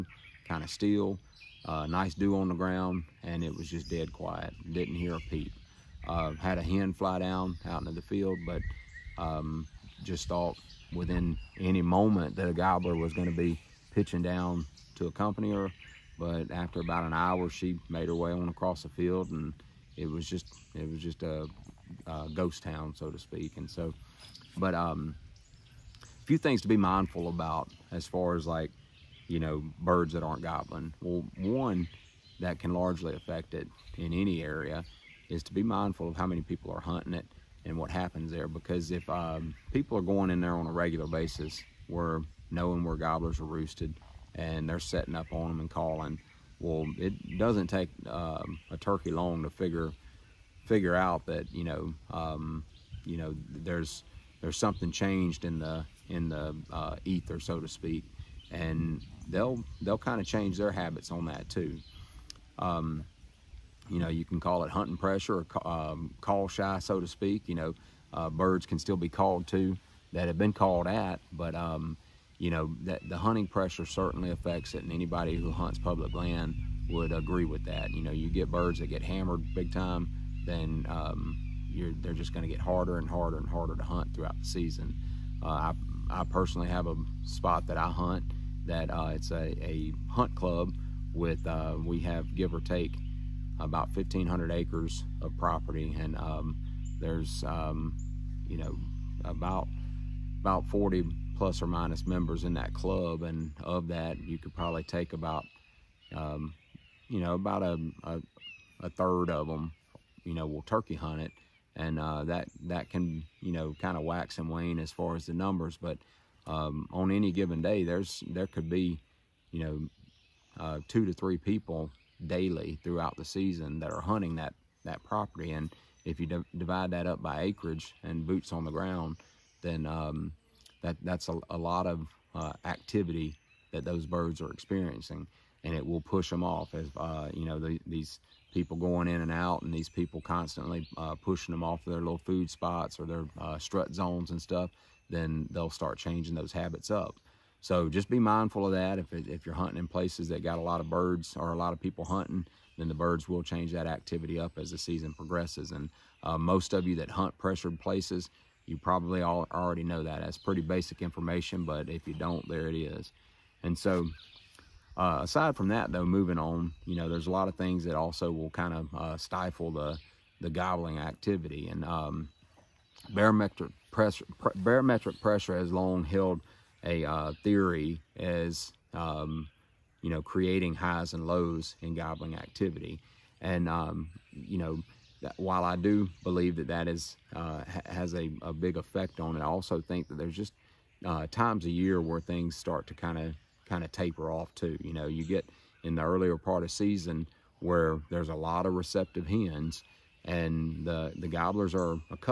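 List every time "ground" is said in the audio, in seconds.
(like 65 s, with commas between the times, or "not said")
2 s, 128 s.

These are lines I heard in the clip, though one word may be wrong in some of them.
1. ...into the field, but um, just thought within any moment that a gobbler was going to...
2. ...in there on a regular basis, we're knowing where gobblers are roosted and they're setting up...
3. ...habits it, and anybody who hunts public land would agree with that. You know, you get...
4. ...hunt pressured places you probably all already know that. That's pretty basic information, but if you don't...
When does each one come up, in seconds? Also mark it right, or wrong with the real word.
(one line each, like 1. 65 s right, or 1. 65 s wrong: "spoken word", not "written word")
1. 7 s right
2. 40 s right
3. 74 s wrong: "affects", not "habits"
4. 157 s right.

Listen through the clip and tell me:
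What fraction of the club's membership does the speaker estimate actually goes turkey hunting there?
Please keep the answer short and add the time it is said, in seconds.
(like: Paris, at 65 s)
a third, at 108 s.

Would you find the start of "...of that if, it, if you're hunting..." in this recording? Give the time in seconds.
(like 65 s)
148 s.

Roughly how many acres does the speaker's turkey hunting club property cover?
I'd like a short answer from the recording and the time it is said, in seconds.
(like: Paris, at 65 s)
1,500, at 93 s.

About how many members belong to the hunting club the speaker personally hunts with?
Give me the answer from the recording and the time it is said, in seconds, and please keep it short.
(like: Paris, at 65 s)
40, at 100 s.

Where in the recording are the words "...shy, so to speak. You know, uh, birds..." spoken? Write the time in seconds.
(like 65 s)
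66 s.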